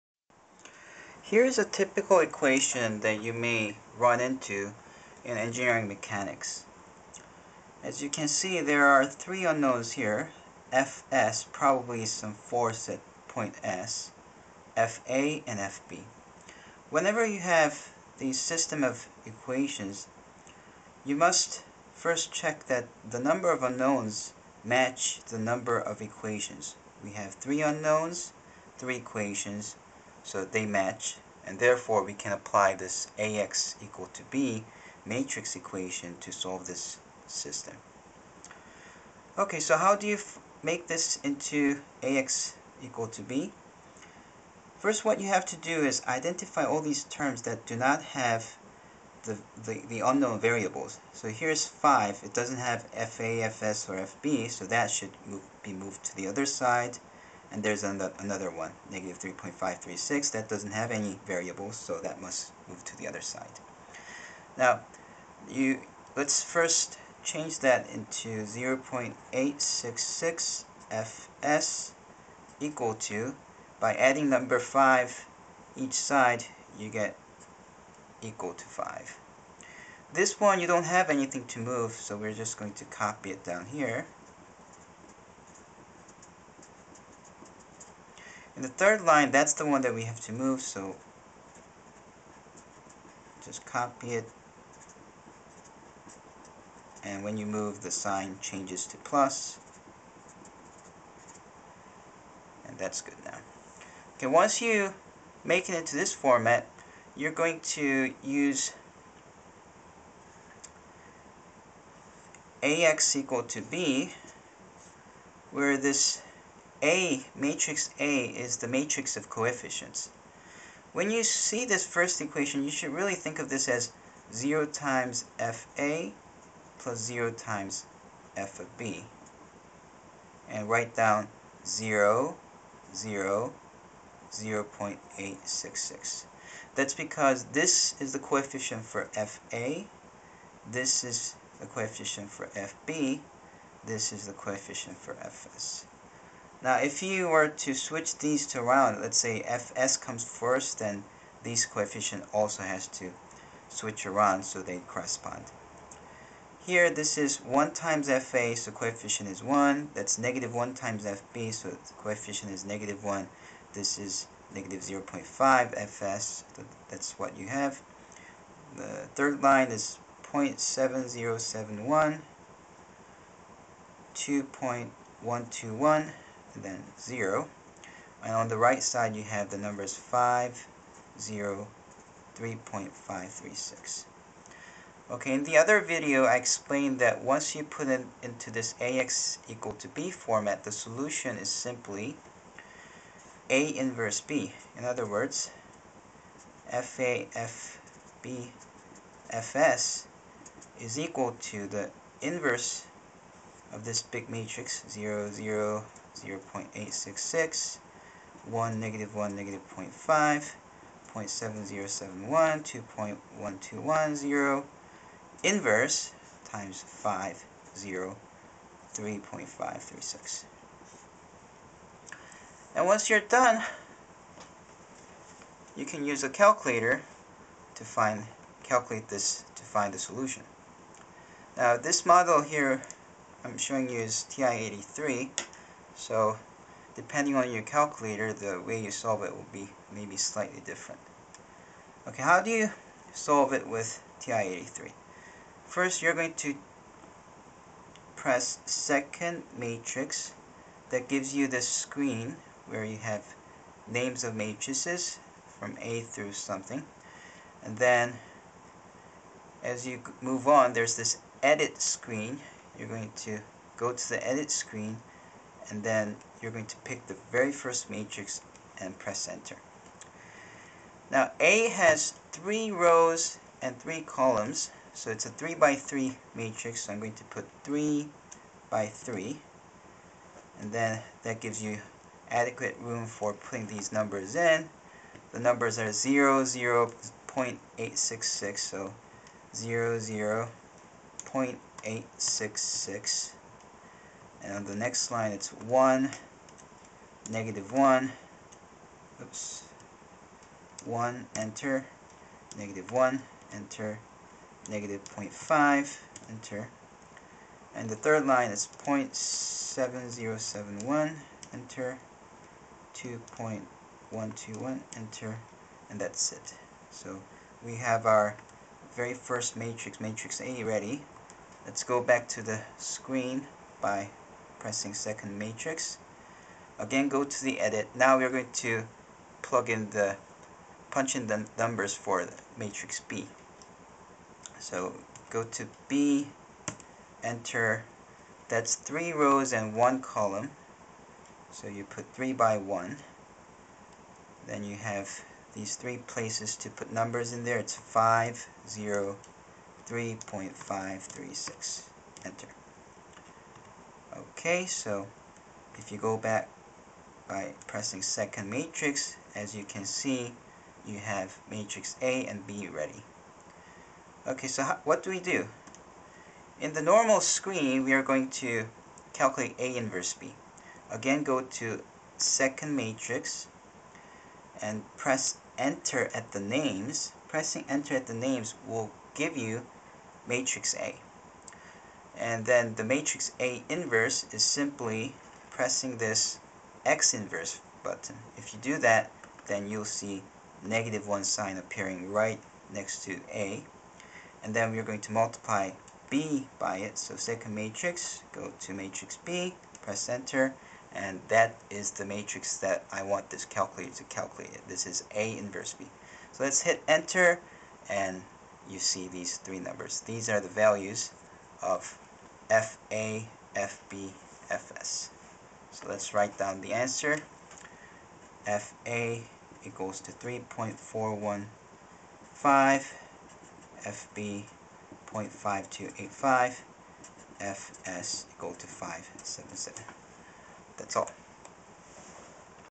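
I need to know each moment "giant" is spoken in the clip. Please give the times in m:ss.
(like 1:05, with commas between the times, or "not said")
not said.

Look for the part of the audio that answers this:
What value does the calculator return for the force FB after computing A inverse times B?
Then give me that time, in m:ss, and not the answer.
7:05.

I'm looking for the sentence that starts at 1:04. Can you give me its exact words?
Now, you let's first change that into 0.866 fs equal to, by adding number 5 each side, you get equal to 5.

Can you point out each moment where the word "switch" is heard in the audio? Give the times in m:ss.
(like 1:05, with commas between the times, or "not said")
2:27, 2:33.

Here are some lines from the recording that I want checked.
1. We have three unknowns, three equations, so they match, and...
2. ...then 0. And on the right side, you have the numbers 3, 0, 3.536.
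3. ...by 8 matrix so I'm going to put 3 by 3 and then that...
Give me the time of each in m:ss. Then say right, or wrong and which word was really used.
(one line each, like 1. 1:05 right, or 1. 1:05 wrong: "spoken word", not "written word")
1. 0:27 right
2. 2:56 wrong: "5", not "3"
3. 4:35 wrong: "3", not "8".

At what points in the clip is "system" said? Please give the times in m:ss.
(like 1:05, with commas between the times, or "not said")
0:18, 0:37.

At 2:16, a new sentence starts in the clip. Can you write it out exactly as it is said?
That's because this is the coefficient for FA, this is the coefficient for FB, this is the coefficient for FS.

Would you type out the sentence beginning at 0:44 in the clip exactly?
First, what you have to do is identify all these terms that do not have the, the, the unknown variables.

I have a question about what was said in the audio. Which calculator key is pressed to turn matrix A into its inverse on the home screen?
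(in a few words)
X inverse button.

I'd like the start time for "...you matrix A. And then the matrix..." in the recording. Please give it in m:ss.
6:19.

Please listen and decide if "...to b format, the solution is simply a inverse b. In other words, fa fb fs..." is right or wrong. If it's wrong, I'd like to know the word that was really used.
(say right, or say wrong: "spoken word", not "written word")
right.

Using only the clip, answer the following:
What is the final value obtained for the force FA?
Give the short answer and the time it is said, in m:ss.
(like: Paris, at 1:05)
3.415, at 7:00.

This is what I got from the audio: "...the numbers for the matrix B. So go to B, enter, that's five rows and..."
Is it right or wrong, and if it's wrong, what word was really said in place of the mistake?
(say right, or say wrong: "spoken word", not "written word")
wrong: "three", not "five".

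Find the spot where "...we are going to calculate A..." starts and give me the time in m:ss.
6:07.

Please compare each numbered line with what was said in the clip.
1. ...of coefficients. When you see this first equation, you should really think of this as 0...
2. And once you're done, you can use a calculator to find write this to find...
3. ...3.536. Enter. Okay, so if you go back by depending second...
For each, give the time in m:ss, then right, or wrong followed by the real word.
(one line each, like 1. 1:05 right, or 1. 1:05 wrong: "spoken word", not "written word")
1. 1:59 right
2. 3:42 wrong: "calculate", not "write"
3. 5:49 wrong: "pressing", not "depending".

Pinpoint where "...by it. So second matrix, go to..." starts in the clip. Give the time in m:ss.
6:36.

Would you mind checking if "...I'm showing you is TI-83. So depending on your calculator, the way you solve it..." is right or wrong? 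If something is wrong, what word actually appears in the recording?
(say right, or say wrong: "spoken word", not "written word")
right.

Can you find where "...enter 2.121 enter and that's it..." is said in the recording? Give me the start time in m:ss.
5:11.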